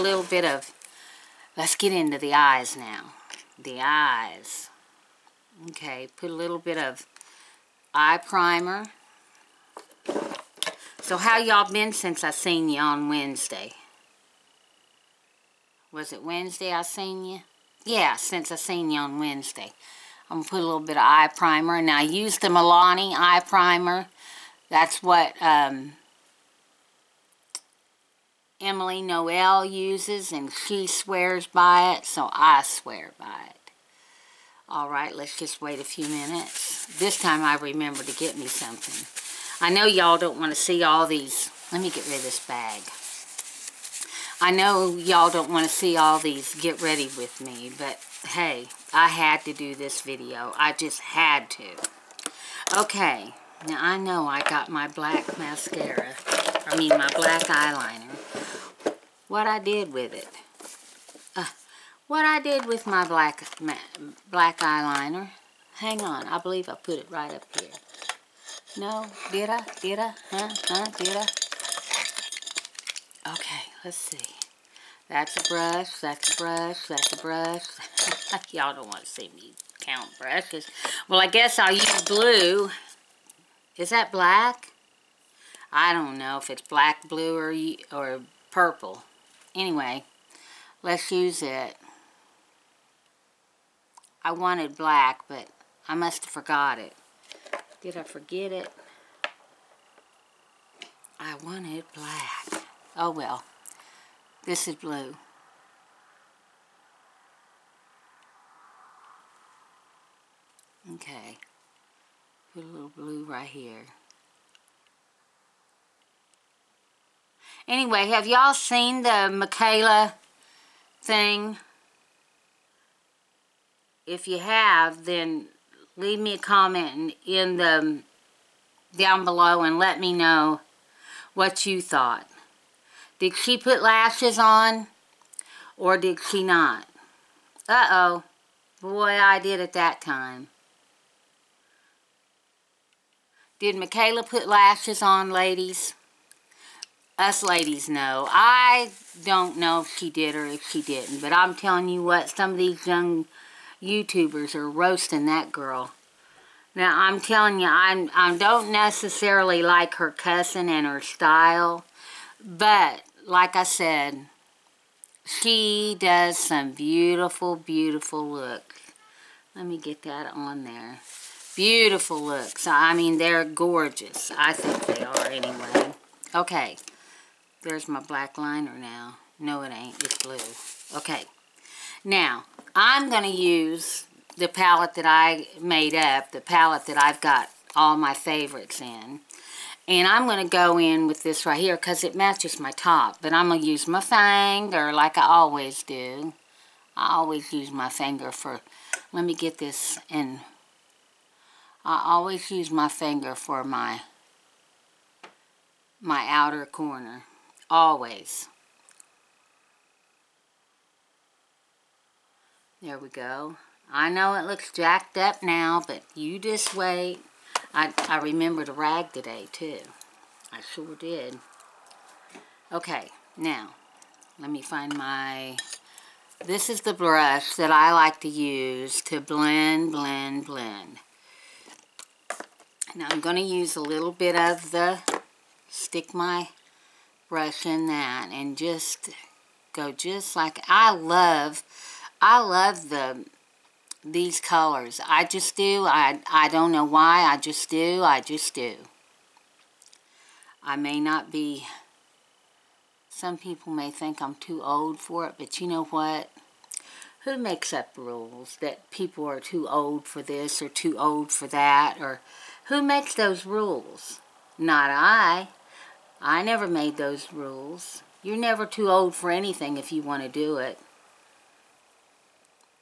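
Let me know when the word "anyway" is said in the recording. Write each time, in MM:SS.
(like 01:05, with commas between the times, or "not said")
01:29, 01:57, 02:55.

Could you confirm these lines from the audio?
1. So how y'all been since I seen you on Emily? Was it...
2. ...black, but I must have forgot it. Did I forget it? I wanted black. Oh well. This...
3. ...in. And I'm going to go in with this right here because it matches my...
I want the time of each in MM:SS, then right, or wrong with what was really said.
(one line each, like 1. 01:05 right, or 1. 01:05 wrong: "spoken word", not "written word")
1. 00:11 wrong: "Wednesday", not "Emily"
2. 01:34 right
3. 03:08 right.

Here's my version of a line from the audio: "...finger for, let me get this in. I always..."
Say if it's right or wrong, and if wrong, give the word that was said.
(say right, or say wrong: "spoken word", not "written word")
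right.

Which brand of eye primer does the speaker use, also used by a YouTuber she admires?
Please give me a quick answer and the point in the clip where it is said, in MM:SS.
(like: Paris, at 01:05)
Milani, at 00:22.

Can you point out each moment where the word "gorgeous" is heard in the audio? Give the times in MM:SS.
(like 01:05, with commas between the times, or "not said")
02:53.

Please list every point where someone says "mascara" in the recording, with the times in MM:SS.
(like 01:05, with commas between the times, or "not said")
00:55.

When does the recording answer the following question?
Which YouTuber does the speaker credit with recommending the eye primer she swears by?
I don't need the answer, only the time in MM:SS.
00:28.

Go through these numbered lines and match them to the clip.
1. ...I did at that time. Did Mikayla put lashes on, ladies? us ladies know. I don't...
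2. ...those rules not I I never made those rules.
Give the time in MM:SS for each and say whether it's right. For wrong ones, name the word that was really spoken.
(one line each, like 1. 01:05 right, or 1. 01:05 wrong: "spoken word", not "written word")
1. 02:19 right
2. 04:23 right.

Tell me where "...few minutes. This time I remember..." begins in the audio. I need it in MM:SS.
00:35.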